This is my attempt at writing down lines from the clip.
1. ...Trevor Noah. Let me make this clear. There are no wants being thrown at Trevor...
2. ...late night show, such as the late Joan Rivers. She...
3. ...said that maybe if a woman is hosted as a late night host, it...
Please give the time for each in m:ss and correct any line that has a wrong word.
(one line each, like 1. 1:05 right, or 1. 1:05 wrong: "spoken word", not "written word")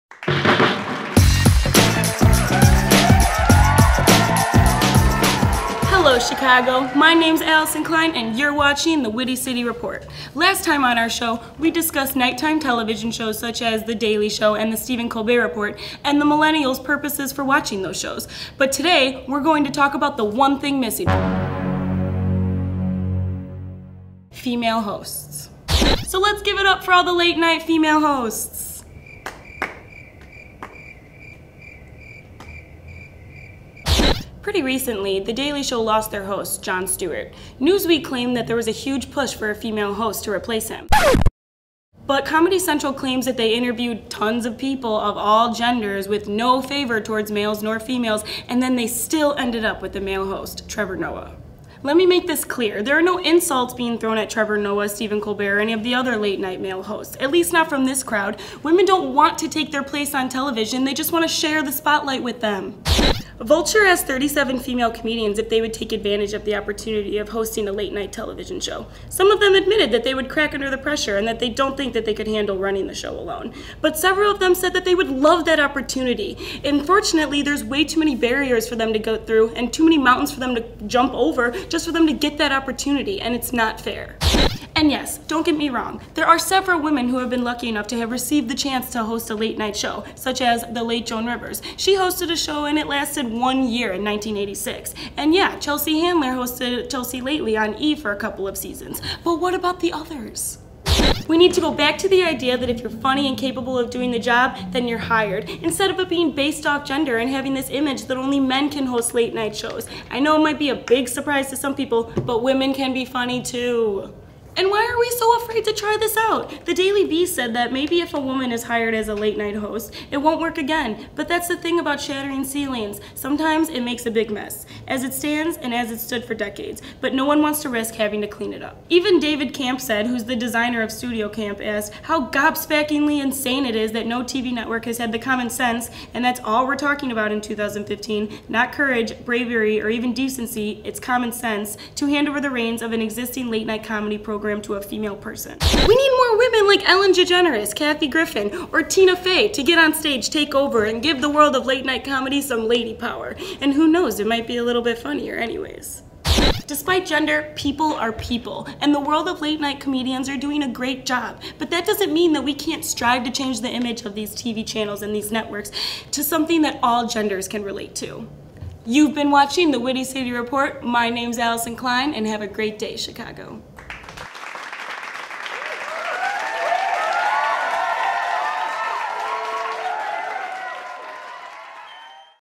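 1. 0:50 wrong: "insults", not "wants"
2. 1:29 right
3. 1:57 wrong: "hired", not "hosted".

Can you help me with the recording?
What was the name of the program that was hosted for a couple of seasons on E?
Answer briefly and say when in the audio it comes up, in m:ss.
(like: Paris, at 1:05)
Chelsea Lately, at 1:36.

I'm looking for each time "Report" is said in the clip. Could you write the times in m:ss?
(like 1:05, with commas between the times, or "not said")
0:09, 0:15, 2:50.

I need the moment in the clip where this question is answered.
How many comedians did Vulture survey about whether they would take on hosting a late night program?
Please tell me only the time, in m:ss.
1:04.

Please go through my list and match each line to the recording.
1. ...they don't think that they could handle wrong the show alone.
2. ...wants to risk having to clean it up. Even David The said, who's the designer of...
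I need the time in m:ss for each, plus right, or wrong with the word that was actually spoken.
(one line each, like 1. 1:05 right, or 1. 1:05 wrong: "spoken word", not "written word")
1. 1:11 wrong: "running", not "wrong"
2. 2:07 wrong: "Camp", not "The".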